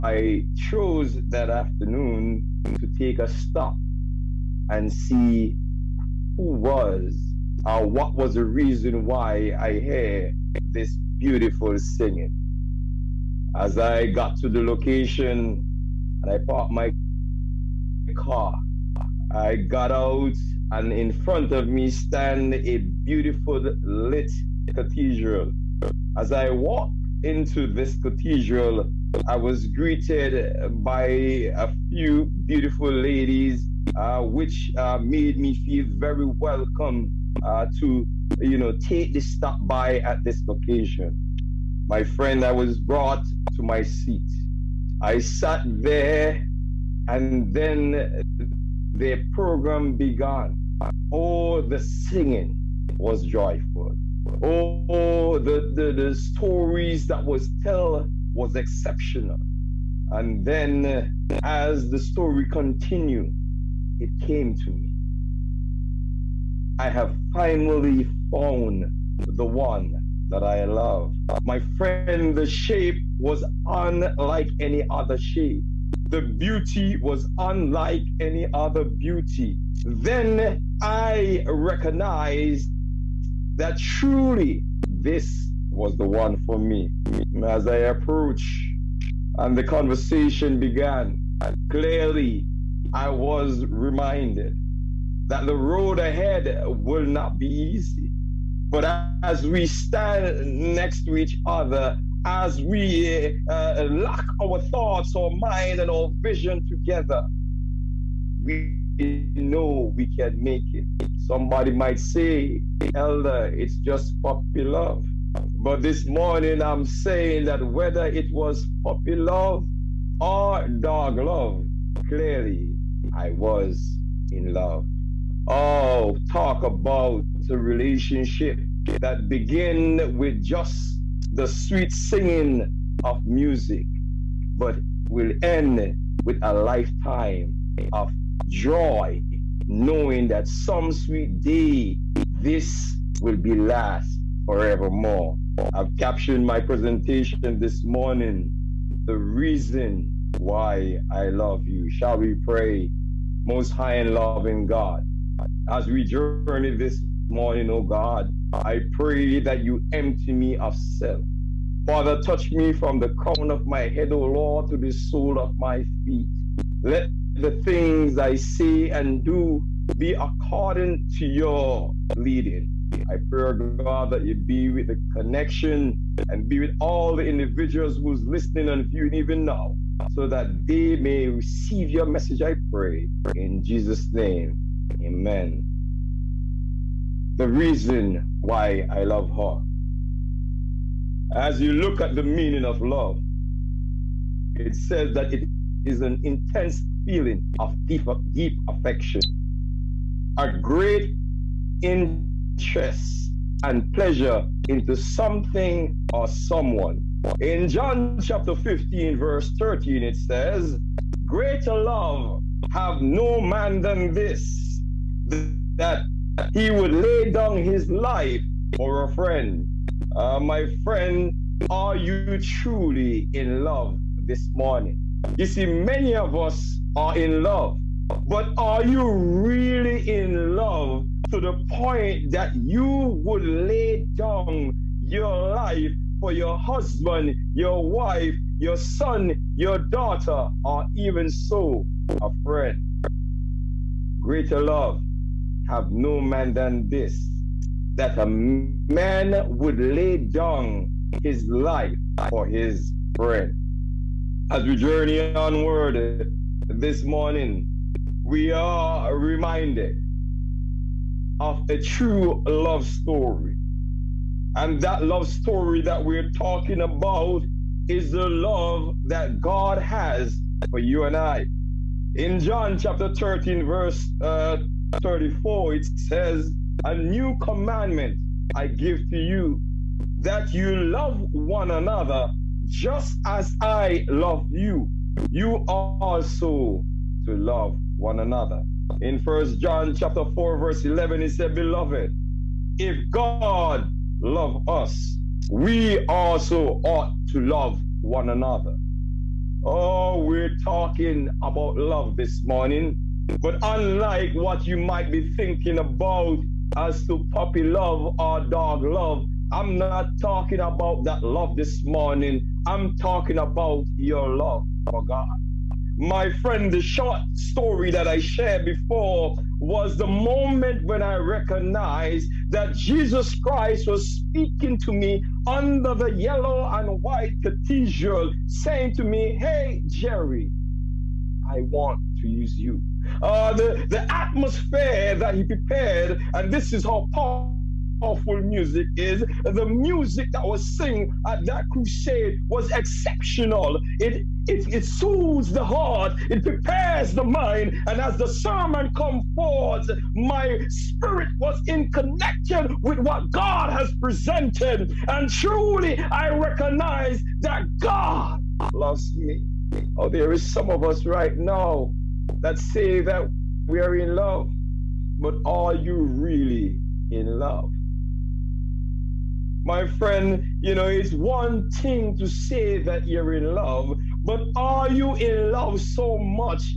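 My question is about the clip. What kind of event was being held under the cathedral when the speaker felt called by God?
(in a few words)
crusade.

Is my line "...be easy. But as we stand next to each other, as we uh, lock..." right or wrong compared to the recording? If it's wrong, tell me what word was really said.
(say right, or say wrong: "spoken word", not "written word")
right.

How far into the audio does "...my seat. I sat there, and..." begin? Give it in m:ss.
0:43.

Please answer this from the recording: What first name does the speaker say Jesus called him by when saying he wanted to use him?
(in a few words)
Jerry.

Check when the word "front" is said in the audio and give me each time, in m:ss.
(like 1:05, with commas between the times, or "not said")
0:21.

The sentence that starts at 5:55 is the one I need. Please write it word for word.
And truly, I recognize that God loves me.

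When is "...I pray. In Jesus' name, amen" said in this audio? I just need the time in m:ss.
3:02.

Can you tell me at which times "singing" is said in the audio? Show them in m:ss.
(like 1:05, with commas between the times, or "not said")
0:11, 0:51, 2:11.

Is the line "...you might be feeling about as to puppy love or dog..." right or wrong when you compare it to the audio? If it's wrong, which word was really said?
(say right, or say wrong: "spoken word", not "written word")
wrong: "thinking", not "feeling".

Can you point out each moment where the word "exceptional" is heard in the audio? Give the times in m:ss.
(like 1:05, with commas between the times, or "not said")
0:58, 5:42.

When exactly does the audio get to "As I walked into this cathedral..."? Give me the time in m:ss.
0:26.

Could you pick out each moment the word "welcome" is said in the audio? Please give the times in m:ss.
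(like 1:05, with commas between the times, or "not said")
0:36.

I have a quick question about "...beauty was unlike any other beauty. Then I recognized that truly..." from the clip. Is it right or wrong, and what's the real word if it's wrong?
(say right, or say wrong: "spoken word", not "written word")
right.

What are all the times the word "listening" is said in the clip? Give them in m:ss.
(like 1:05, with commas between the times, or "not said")
2:58.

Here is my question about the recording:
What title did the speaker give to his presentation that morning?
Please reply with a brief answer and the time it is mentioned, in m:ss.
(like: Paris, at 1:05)
The Reason why I love you, at 2:29.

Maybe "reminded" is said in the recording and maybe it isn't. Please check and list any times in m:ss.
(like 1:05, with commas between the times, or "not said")
1:33, 4:19.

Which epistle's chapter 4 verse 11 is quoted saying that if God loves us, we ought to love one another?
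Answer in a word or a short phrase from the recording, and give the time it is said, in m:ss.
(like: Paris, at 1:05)
First John, at 4:49.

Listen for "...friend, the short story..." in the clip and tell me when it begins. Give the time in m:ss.
5:16.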